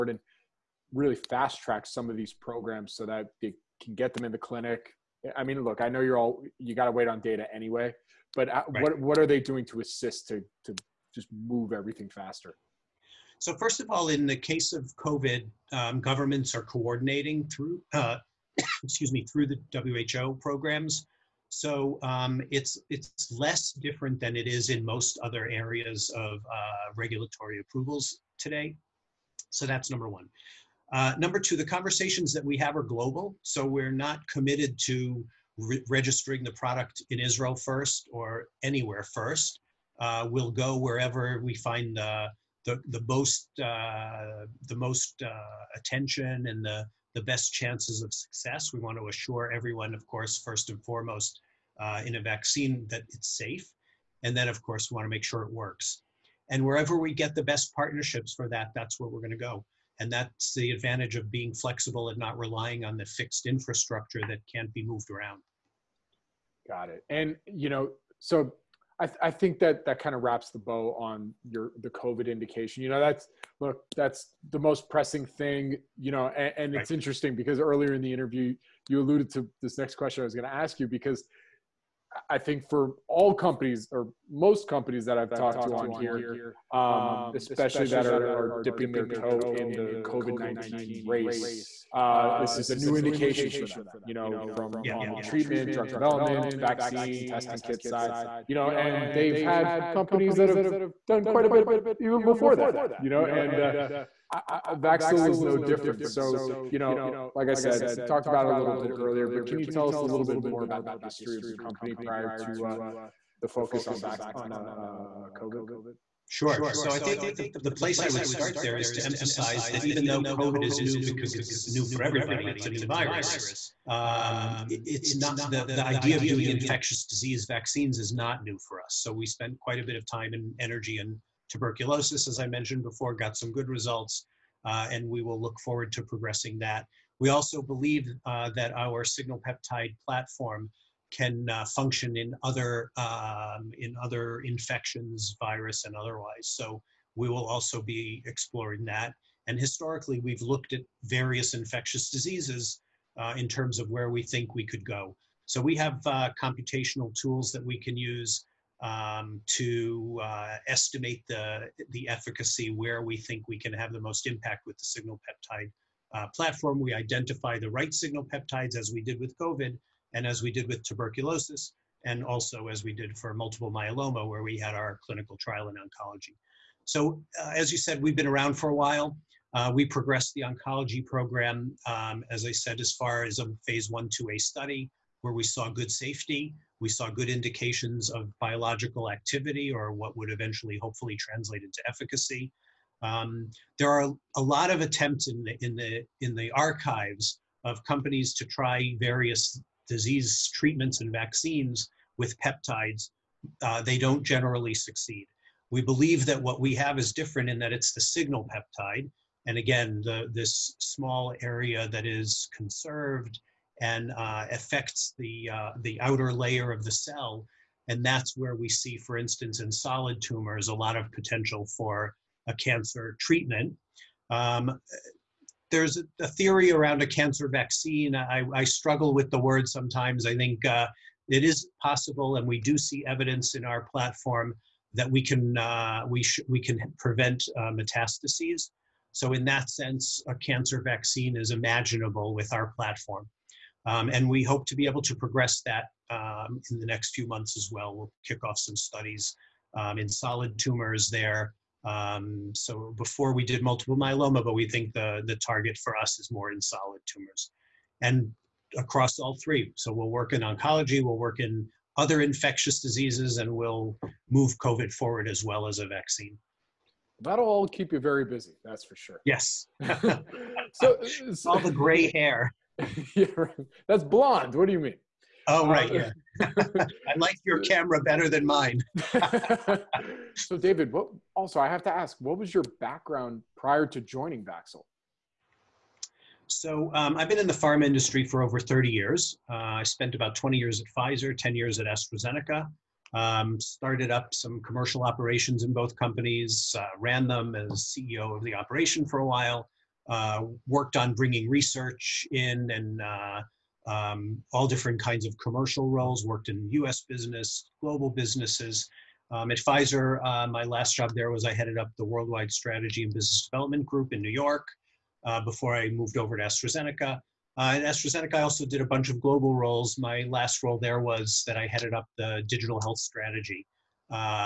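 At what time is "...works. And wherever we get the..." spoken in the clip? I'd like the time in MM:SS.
00:55.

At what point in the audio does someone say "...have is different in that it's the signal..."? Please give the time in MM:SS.
03:26.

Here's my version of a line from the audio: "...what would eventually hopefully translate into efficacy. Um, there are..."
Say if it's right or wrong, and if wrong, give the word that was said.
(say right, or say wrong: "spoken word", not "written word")
right.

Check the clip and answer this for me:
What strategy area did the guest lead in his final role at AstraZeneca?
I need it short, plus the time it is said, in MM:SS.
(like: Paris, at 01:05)
Digital health, at 05:22.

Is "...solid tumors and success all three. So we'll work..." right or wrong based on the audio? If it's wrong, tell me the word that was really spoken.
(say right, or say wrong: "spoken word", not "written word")
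wrong: "across", not "success".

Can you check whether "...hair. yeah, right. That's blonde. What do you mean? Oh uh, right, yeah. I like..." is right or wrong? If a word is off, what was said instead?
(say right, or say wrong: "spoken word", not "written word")
right.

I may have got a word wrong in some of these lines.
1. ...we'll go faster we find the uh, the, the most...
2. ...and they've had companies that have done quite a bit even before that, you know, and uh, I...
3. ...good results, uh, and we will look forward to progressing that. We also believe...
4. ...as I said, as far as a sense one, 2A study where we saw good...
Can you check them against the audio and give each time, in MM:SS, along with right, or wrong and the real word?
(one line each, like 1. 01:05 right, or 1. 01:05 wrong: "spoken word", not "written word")
1. 00:40 wrong: "wherever", not "faster"
2. 01:38 right
3. 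02:13 right
4. 03:02 wrong: "phase", not "sense".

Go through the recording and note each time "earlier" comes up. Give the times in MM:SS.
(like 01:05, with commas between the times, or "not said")
01:17, 01:48.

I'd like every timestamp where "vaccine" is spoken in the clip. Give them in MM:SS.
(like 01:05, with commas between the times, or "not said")
00:52, 01:36, 02:07, 03:21, 03:47, 04:00, 04:25.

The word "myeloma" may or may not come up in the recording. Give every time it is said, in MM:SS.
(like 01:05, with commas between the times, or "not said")
02:53, 04:13.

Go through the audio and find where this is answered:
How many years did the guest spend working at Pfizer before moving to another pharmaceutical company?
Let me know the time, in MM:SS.
04:50.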